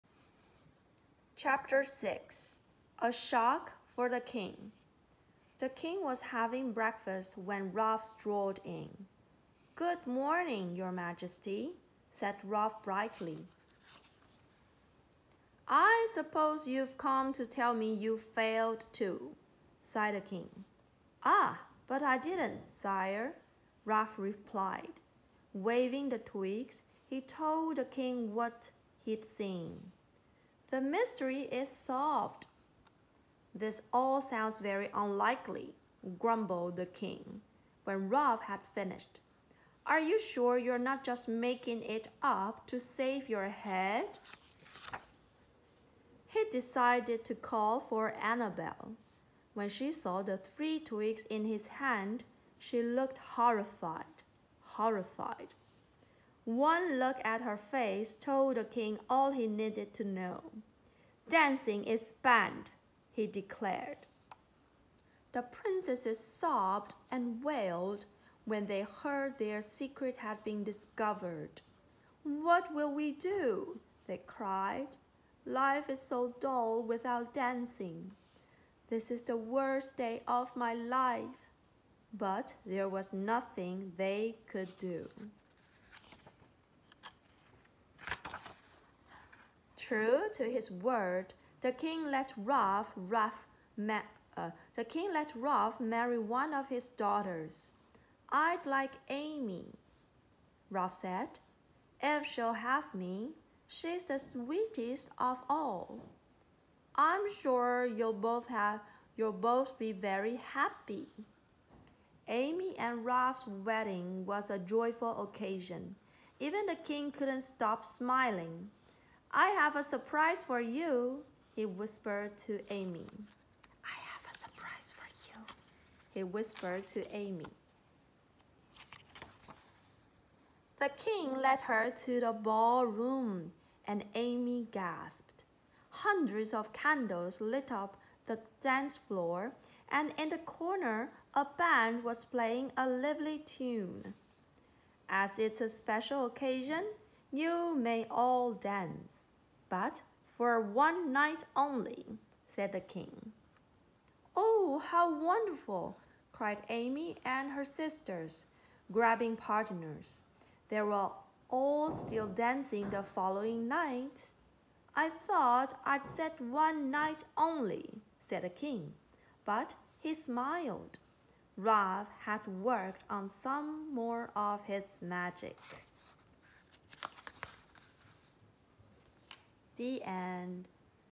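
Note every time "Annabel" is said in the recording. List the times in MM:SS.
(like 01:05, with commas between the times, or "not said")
00:48.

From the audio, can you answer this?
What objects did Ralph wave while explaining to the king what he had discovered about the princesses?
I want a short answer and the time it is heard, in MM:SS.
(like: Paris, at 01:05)
Three twigs, at 00:50.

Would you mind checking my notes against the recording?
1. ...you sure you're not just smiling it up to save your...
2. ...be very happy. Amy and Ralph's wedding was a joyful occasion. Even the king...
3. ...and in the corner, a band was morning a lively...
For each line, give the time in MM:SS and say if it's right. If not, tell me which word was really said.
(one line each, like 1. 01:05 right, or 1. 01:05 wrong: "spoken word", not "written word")
1. 00:39 wrong: "making", not "smiling"
2. 01:49 right
3. 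02:19 wrong: "playing", not "morning".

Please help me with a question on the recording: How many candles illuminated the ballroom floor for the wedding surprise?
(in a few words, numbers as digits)
Hundreds.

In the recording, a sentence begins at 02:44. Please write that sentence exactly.
I thought I'd said one night only, said the king, but he smiled.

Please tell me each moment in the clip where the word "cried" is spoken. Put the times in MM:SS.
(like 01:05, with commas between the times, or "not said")
01:14, 02:36.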